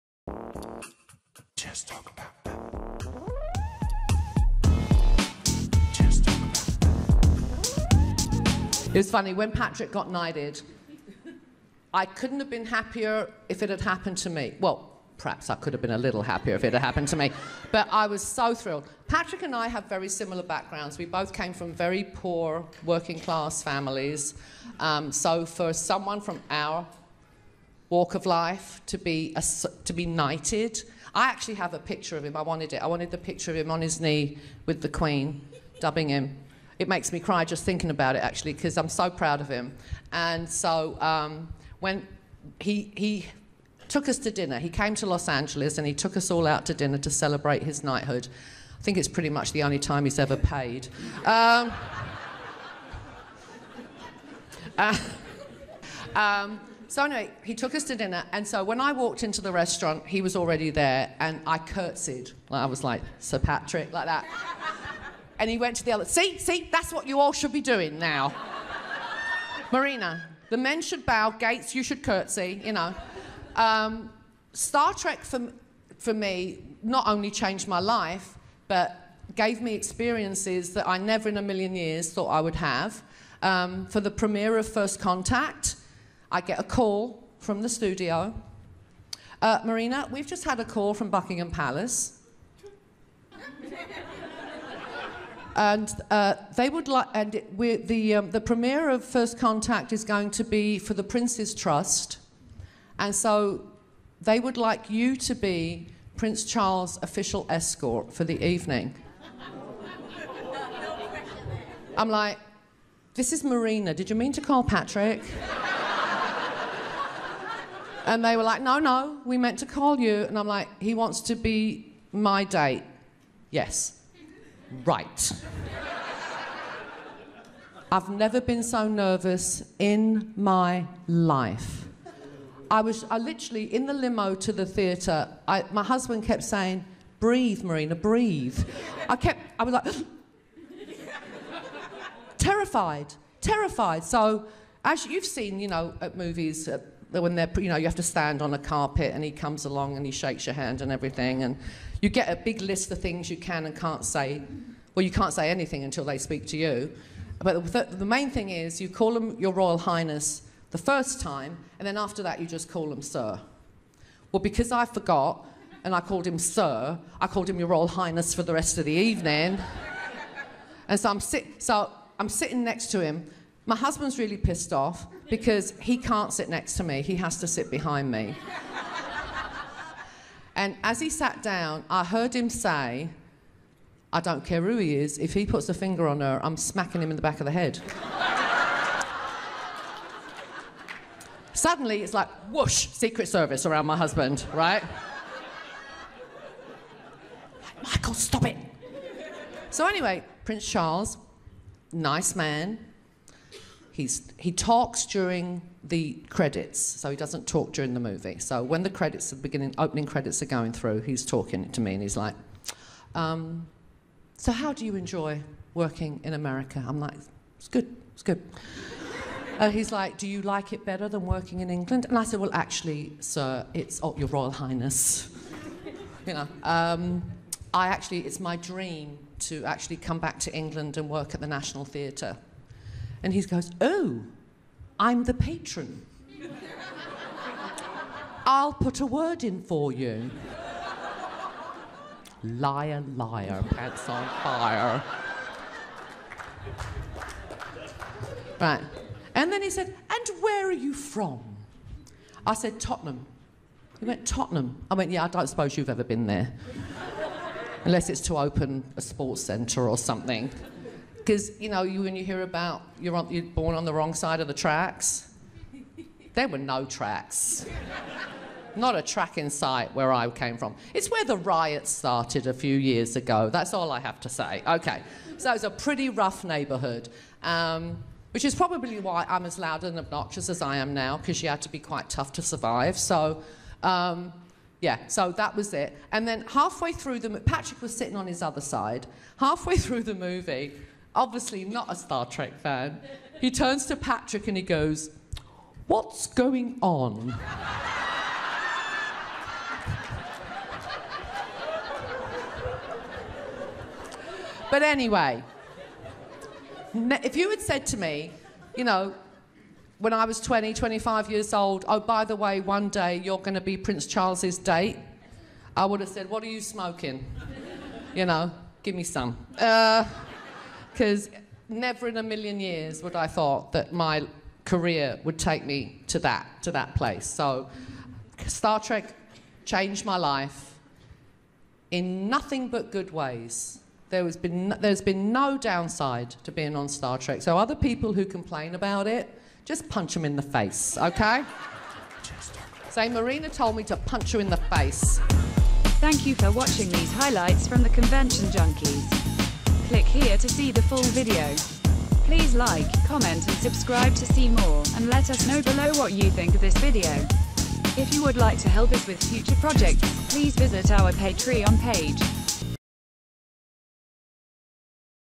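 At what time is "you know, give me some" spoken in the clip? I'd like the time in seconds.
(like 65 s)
318 s.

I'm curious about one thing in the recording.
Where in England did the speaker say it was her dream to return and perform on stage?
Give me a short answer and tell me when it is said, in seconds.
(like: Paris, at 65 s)
National Theatre, at 231 s.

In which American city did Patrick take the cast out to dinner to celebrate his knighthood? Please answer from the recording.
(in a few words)
Los Angeles.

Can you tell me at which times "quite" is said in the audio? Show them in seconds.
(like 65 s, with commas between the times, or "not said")
281 s.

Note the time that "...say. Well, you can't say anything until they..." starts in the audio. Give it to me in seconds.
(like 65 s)
154 s.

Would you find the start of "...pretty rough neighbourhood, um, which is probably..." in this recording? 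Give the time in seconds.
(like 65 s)
275 s.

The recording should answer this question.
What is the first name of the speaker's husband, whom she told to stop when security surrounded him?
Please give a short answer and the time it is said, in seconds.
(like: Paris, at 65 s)
Michael, at 197 s.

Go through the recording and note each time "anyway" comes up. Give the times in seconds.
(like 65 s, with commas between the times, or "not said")
57 s, 199 s, 304 s.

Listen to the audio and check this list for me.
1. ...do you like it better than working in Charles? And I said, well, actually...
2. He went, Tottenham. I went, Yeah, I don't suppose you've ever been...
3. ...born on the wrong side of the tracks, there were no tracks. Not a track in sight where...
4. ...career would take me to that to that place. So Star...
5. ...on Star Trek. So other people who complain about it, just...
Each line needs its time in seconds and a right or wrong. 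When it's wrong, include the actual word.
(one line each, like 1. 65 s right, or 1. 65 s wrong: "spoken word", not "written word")
1. 220 s wrong: "England", not "Charles"
2. 253 s right
3. 263 s right
4. 324 s right
5. 336 s right.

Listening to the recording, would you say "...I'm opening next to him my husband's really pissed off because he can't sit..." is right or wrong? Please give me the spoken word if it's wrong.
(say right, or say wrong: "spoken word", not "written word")
wrong: "sitting", not "opening".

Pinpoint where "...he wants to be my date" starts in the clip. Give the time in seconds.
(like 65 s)
120 s.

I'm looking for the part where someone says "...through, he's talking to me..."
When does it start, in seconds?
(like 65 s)
210 s.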